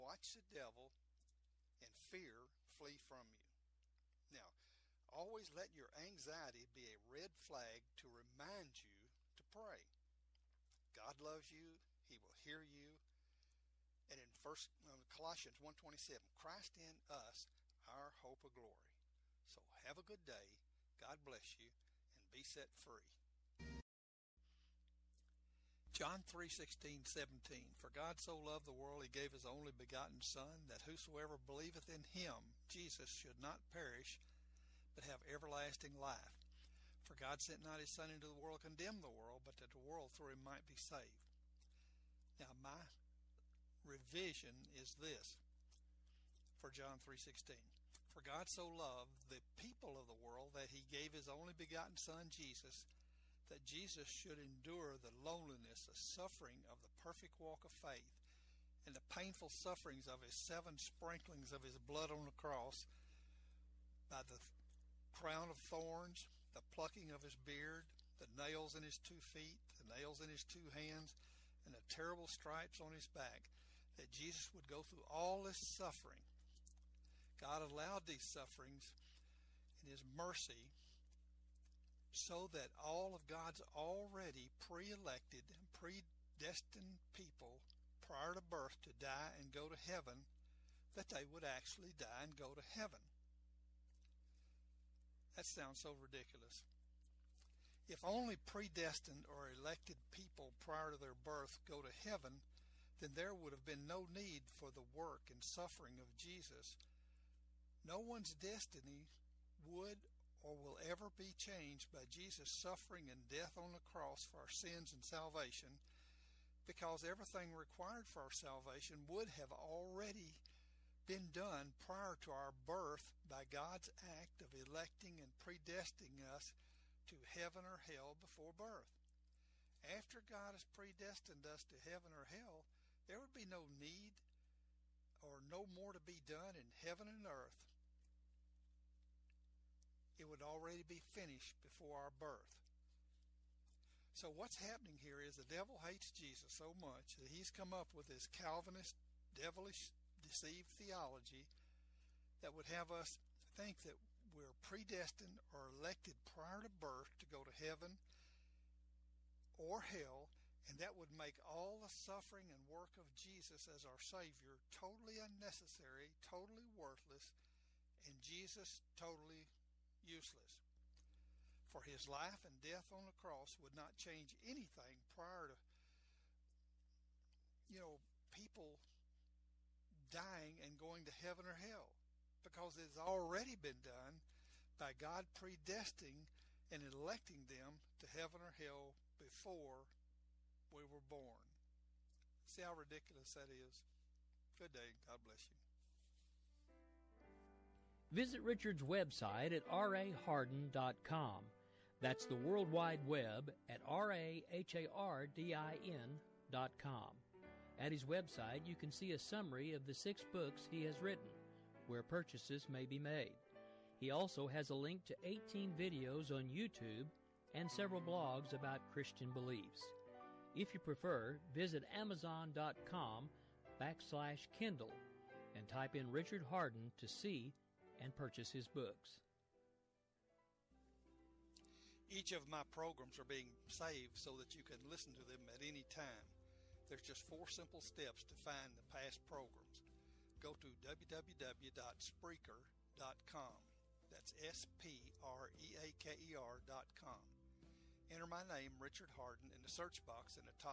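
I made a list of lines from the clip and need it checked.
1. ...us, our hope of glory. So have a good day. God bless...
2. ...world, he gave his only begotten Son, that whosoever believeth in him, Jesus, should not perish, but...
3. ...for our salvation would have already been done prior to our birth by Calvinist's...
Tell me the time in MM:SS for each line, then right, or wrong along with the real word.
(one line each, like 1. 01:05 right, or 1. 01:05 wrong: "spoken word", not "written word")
1. 00:17 right
2. 00:28 right
3. 01:58 wrong: "God", not "Calvinist".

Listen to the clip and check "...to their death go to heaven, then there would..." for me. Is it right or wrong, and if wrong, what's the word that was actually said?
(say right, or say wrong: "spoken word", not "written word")
wrong: "birth", not "death".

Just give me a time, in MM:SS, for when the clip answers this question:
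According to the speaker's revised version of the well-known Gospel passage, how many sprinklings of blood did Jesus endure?
01:00.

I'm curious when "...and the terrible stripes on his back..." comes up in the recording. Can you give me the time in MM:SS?
01:11.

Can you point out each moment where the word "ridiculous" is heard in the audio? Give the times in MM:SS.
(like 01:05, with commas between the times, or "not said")
01:35, 03:12.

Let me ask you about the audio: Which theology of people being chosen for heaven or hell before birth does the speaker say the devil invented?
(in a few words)
Calvinist.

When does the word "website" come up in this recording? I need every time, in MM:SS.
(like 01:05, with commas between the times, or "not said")
03:18, 03:28.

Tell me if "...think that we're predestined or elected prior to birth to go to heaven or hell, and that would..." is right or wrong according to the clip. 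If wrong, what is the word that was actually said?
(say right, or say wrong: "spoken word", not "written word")
right.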